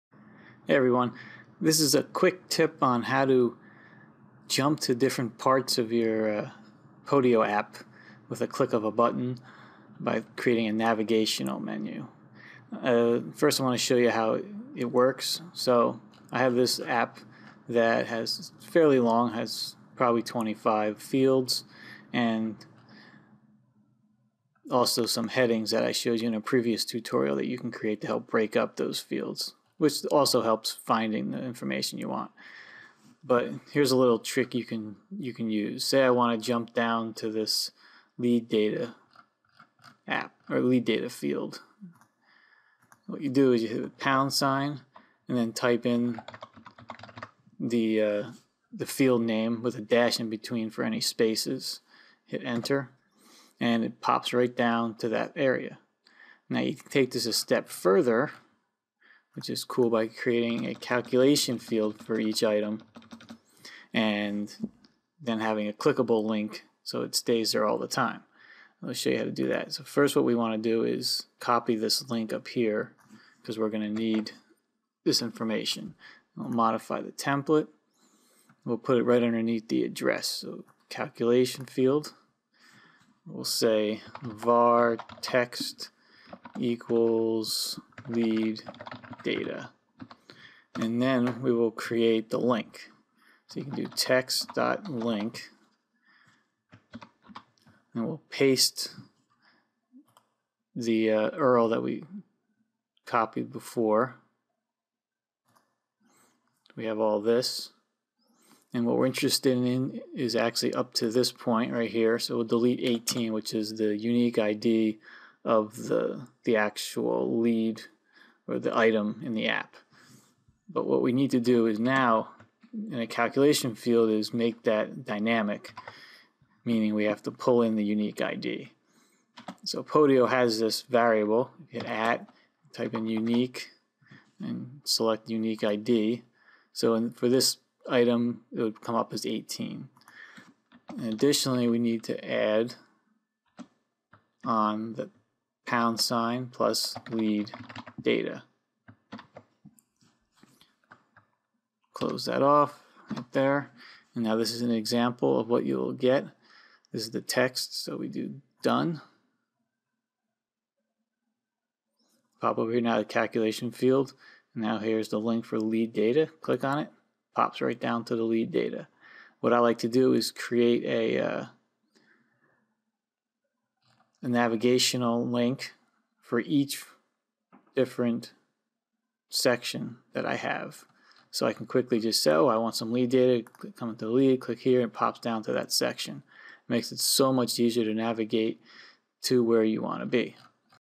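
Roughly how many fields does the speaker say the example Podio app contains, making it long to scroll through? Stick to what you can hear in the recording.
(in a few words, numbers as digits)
25.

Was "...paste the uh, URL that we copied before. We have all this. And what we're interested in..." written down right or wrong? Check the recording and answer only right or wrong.
right.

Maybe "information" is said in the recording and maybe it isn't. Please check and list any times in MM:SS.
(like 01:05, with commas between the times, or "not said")
00:31, 01:15.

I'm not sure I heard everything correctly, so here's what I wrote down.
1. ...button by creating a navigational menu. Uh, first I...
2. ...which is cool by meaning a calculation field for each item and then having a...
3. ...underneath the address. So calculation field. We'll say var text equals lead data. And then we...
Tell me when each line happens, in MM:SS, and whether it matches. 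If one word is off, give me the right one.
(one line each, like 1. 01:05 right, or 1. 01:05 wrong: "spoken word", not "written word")
1. 00:08 right
2. 00:59 wrong: "creating", not "meaning"
3. 01:19 right.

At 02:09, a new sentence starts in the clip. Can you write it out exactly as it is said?
So Podio has this variable, hit at, type in unique, and select unique ID.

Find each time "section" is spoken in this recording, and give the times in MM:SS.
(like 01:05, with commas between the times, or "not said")
02:59, 03:05.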